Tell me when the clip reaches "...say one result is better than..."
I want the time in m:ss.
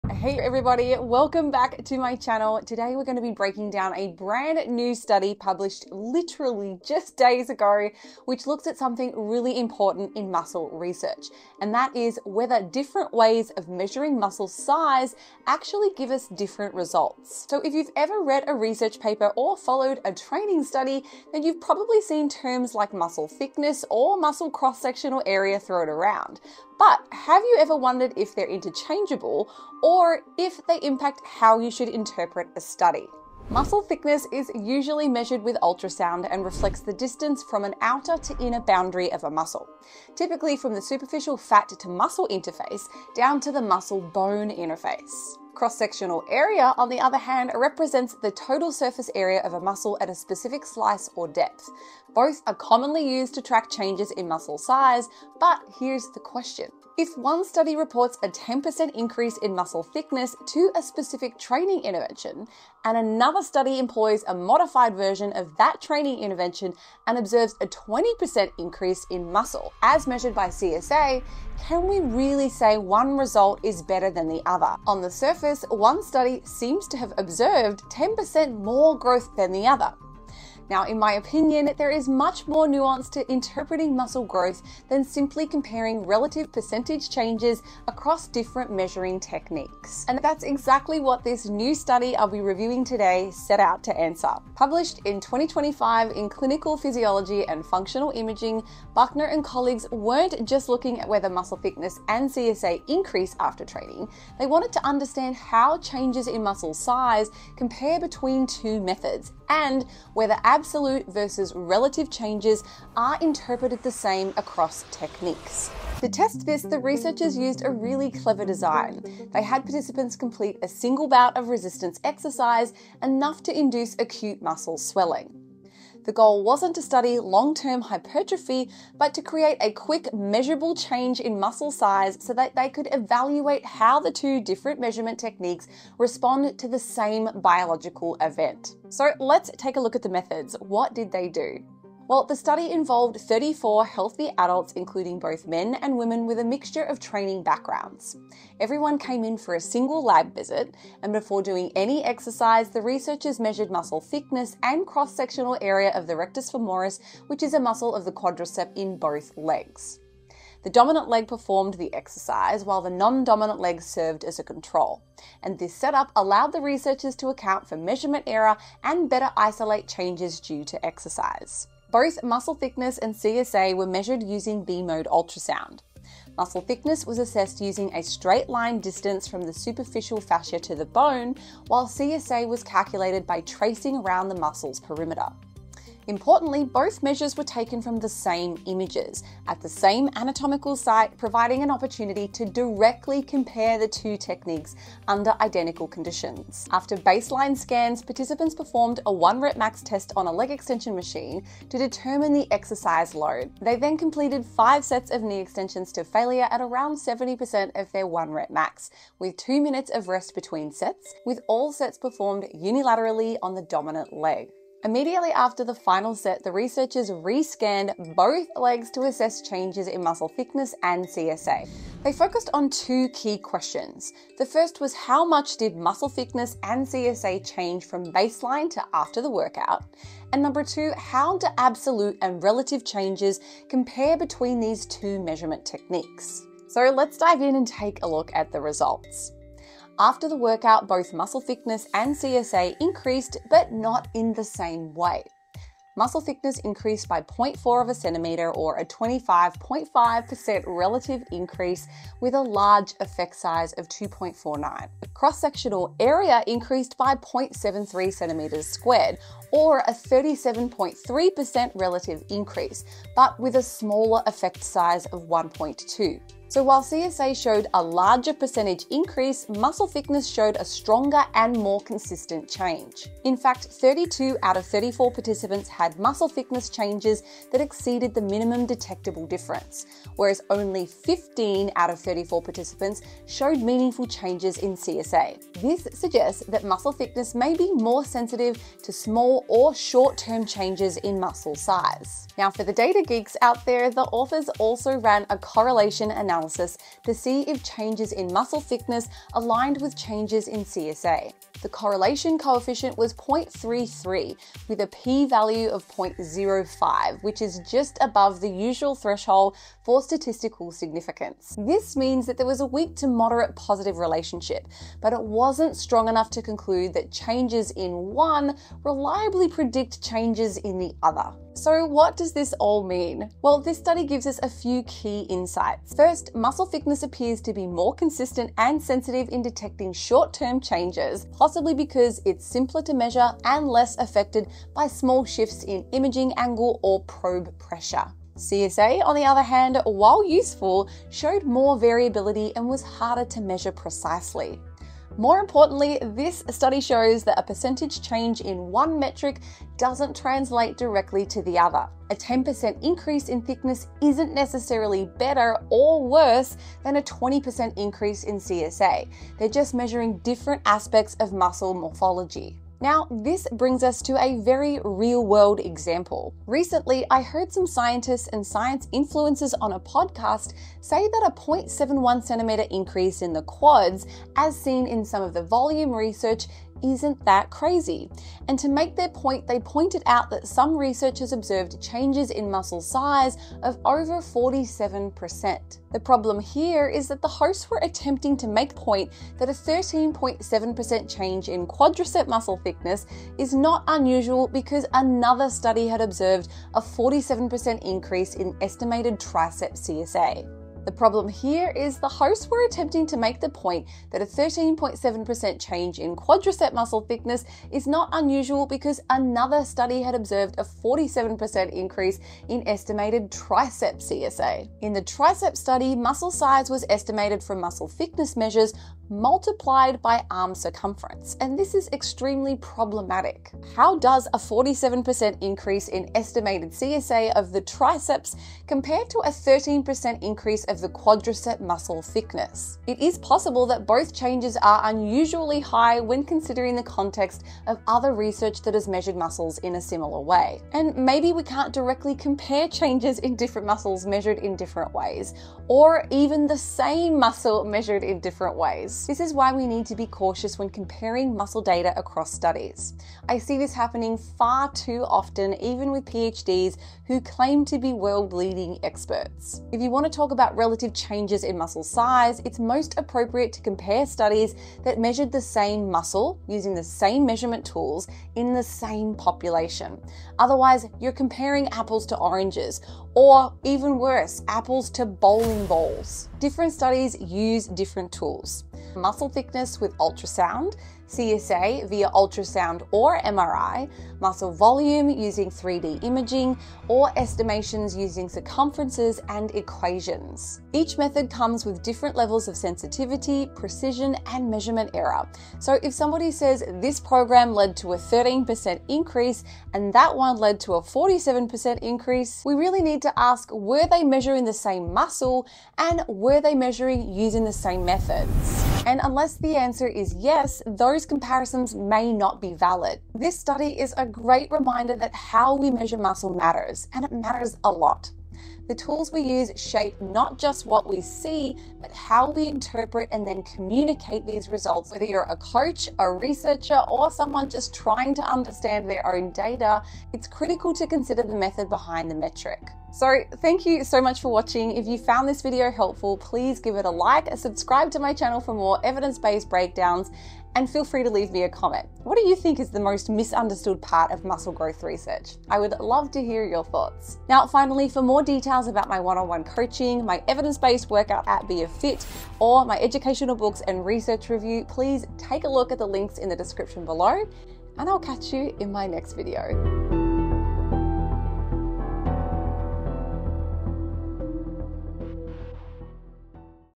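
1:12.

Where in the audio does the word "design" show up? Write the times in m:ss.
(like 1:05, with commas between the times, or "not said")
1:58.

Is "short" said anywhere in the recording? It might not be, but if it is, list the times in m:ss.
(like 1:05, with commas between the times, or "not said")
4:49, 5:29.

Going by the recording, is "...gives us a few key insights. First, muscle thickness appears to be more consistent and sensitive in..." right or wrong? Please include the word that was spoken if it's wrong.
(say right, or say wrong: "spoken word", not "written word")
right.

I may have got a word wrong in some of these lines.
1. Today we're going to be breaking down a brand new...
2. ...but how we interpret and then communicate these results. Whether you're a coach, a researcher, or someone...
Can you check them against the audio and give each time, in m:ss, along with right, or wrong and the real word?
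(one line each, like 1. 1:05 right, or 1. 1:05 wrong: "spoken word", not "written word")
1. 0:02 right
2. 8:41 right.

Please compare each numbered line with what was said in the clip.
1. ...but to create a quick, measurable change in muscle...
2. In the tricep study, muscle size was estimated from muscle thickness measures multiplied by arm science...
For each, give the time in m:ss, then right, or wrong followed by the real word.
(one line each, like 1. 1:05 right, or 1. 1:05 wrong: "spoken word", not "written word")
1. 2:08 right
2. 6:54 wrong: "circumference", not "science".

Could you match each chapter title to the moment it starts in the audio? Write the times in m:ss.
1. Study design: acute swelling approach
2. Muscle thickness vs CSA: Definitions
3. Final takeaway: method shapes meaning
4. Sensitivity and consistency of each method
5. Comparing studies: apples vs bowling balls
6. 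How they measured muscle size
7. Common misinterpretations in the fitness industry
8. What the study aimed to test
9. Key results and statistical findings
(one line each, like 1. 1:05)
1. 2:10
2. 0:32
3. 8:50
4. 5:24
5. 8:16
6. 3:12
7. 7:09
8. 1:38
9. 4:11.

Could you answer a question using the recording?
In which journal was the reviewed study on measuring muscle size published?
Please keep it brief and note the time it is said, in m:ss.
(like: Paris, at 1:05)
Clinical Physiology and Functional Imaging, at 1:36.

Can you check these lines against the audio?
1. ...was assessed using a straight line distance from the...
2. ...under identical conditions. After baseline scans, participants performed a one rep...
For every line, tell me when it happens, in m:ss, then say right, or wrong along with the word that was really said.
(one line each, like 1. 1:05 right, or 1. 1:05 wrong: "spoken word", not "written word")
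1. 2:57 right
2. 3:15 right.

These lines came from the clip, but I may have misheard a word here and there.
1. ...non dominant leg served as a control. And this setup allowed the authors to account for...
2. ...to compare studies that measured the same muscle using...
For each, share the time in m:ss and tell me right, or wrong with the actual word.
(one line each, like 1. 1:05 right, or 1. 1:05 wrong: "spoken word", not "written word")
1. 2:42 wrong: "researchers", not "authors"
2. 7:43 right.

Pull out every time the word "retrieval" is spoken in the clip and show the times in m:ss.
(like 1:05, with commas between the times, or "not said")
not said.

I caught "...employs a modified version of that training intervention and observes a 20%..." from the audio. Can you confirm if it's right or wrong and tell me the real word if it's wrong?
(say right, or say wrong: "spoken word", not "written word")
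right.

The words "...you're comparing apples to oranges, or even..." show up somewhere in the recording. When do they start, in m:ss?
7:50.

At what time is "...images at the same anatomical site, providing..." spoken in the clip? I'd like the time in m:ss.
3:08.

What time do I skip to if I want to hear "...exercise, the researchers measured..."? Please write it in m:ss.
2:32.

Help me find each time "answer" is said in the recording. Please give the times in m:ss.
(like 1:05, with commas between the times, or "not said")
1:33, 8:29.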